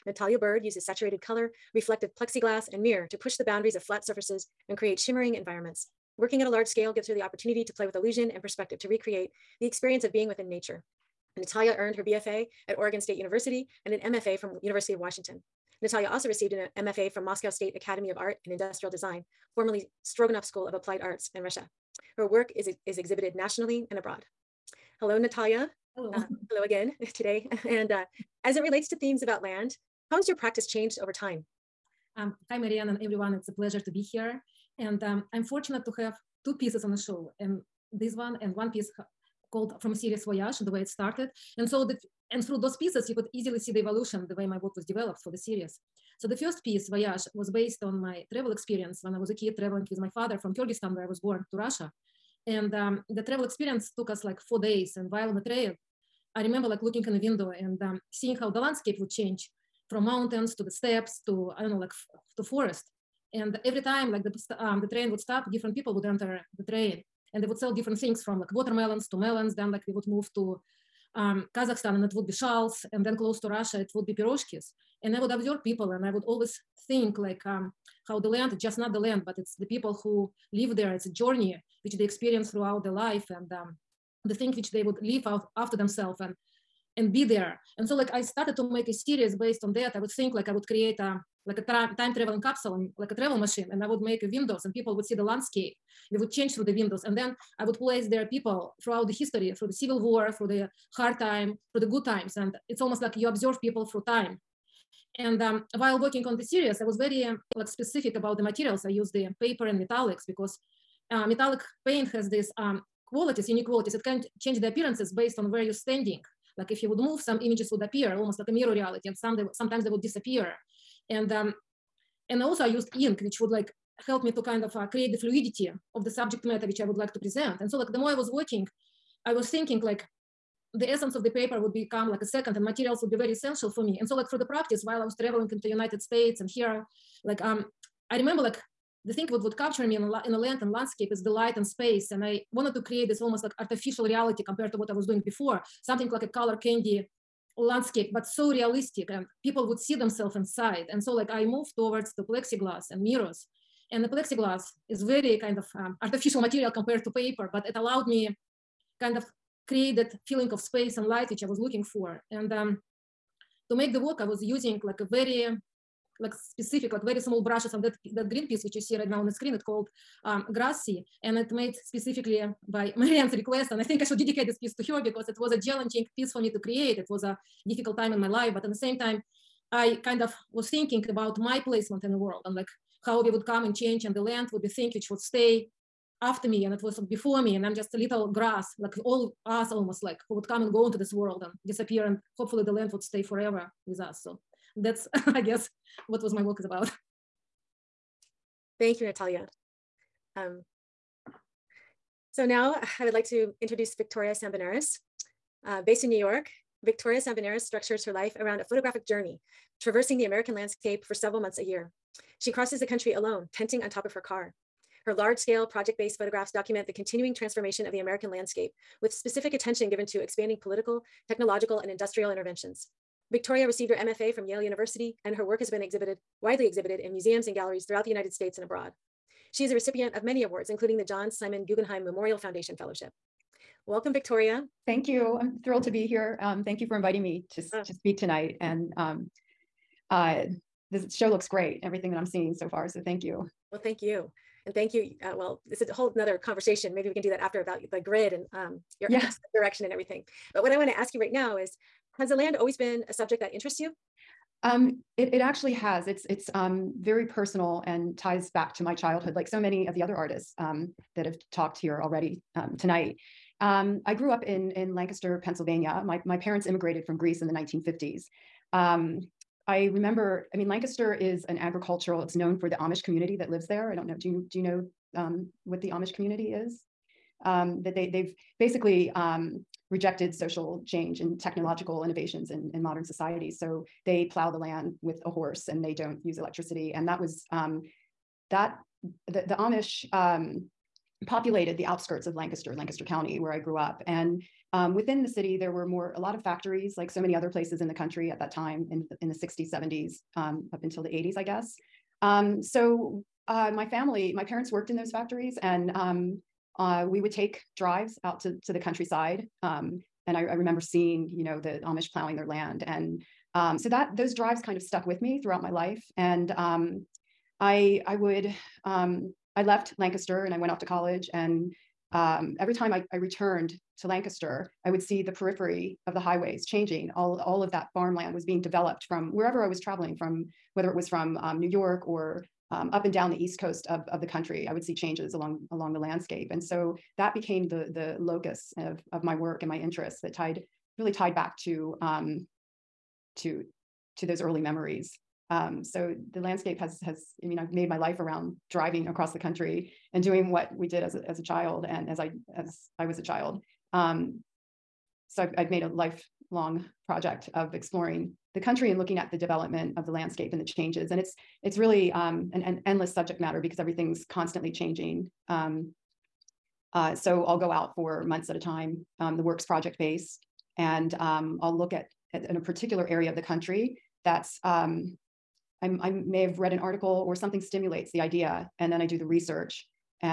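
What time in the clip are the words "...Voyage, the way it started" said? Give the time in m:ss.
0:40.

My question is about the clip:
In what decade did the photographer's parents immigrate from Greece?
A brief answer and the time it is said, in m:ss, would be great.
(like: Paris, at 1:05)
1950s, at 4:27.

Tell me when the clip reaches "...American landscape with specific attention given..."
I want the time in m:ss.
3:37.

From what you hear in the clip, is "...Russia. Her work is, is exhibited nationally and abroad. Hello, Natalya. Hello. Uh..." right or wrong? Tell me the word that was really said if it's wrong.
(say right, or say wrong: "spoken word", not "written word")
right.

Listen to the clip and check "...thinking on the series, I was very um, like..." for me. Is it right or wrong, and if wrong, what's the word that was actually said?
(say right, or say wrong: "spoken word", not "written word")
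wrong: "working", not "thinking".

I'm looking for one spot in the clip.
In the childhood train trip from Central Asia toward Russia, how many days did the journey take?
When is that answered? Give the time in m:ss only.
0:54.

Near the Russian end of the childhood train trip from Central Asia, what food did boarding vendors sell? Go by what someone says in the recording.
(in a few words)
Piroshkis.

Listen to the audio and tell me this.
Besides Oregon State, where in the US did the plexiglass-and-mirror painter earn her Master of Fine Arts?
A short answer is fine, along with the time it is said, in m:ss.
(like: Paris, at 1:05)
University of Washington, at 0:14.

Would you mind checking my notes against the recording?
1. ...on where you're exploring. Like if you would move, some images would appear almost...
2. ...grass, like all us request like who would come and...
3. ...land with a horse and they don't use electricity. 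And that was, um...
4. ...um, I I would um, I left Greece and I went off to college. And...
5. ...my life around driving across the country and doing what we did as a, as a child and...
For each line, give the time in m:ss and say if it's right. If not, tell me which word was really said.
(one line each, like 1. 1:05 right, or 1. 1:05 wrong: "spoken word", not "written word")
1. 1:55 wrong: "standing", not "exploring"
2. 3:08 wrong: "almost", not "request"
3. 4:44 right
4. 5:16 wrong: "Lancaster", not "Greece"
5. 5:47 right.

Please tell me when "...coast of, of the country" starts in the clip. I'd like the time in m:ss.
5:33.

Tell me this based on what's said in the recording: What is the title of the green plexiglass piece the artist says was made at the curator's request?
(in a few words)
Grassy.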